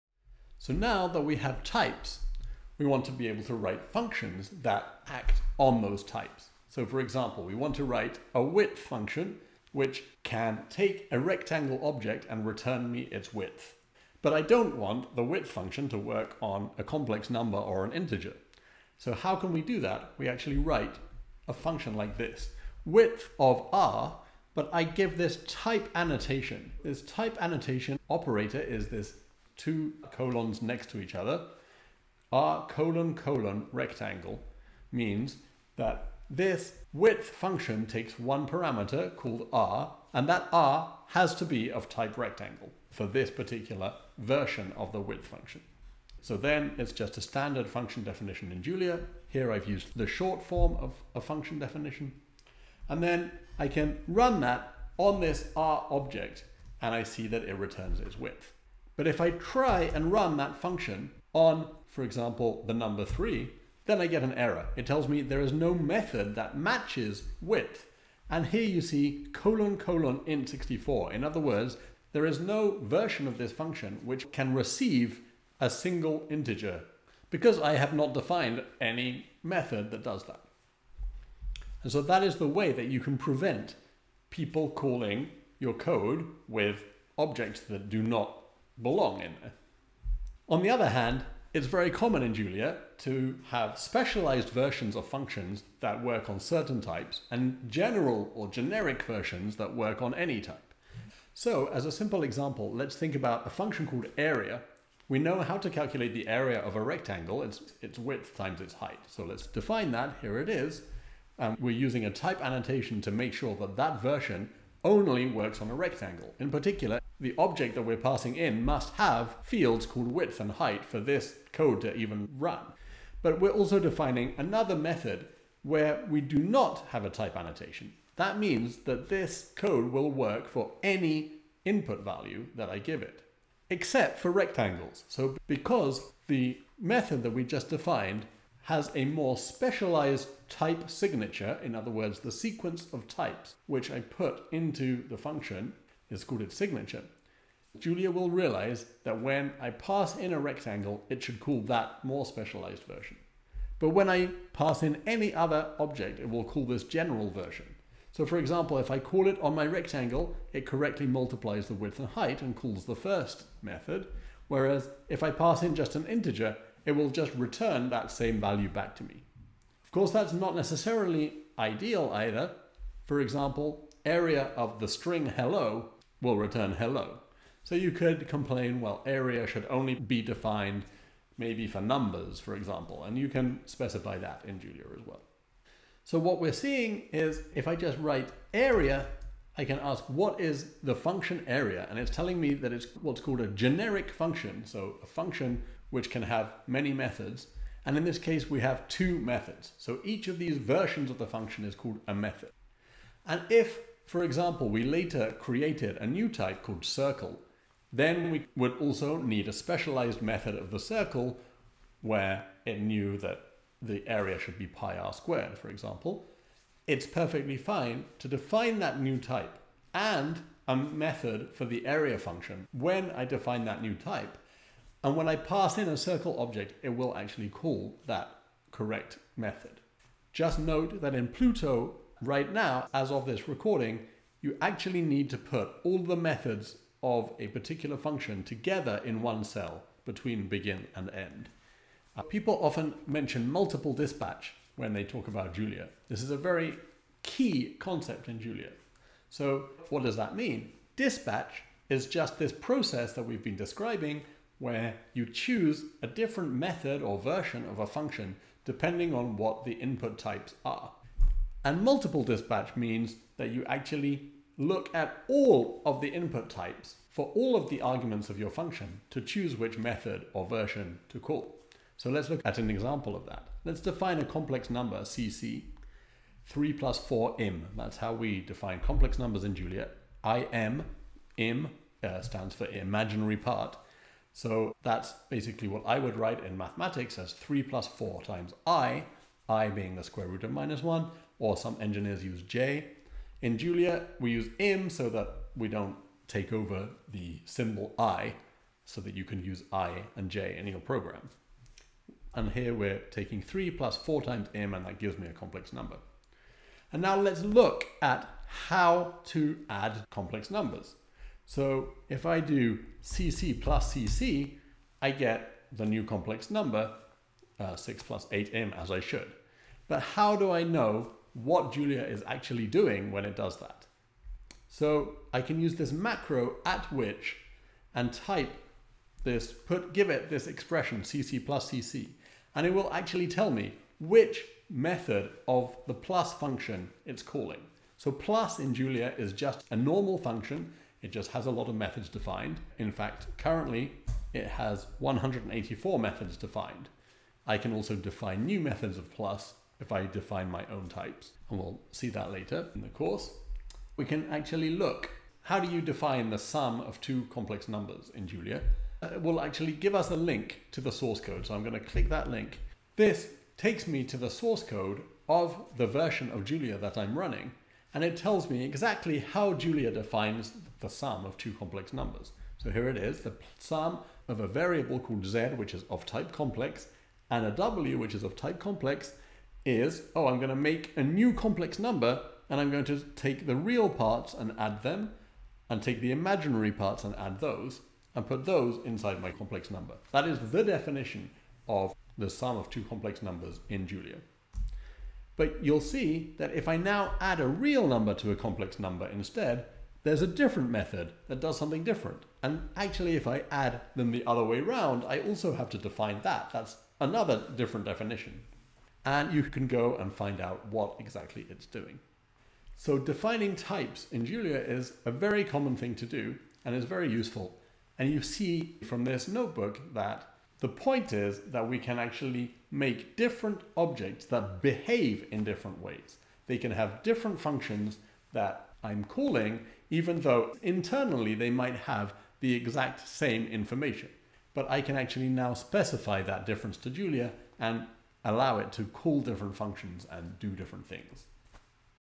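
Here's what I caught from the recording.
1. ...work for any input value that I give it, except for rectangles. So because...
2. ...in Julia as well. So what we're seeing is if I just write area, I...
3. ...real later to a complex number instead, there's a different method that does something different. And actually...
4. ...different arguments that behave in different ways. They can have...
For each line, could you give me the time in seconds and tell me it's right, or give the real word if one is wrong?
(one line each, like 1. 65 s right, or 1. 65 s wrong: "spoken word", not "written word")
1. 130 s right
2. 184 s right
3. 397 s wrong: "number", not "later"
4. 423 s wrong: "objects", not "arguments".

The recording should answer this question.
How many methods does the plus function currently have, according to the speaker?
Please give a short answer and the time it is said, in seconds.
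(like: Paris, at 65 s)
184, at 344 s.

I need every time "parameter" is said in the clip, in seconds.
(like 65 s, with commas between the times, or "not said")
38 s.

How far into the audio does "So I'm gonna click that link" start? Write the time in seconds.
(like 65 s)
361 s.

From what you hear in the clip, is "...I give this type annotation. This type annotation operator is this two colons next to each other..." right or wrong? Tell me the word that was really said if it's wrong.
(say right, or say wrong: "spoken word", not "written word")
right.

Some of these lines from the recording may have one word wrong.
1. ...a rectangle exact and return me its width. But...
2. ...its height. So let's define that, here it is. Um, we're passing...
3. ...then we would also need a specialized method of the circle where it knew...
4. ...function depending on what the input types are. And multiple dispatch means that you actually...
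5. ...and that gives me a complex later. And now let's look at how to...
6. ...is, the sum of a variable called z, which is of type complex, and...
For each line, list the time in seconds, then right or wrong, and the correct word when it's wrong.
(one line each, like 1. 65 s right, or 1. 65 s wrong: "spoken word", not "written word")
1. 11 s wrong: "object", not "exact"
2. 108 s wrong: "using", not "passing"
3. 207 s right
4. 257 s right
5. 304 s wrong: "number", not "later"
6. 372 s right.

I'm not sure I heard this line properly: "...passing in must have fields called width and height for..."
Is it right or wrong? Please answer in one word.
right.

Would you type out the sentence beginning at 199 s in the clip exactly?
So each of these versions of the function is called a method.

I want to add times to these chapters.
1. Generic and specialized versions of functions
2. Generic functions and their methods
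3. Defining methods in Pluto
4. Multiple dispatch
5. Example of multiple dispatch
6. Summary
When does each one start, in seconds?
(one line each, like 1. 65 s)
1. 90 s
2. 186 s
3. 230 s
4. 241 s
5. 271 s
6. 412 s.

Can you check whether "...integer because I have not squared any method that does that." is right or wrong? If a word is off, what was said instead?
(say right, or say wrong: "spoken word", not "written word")
wrong: "defined", not "squared".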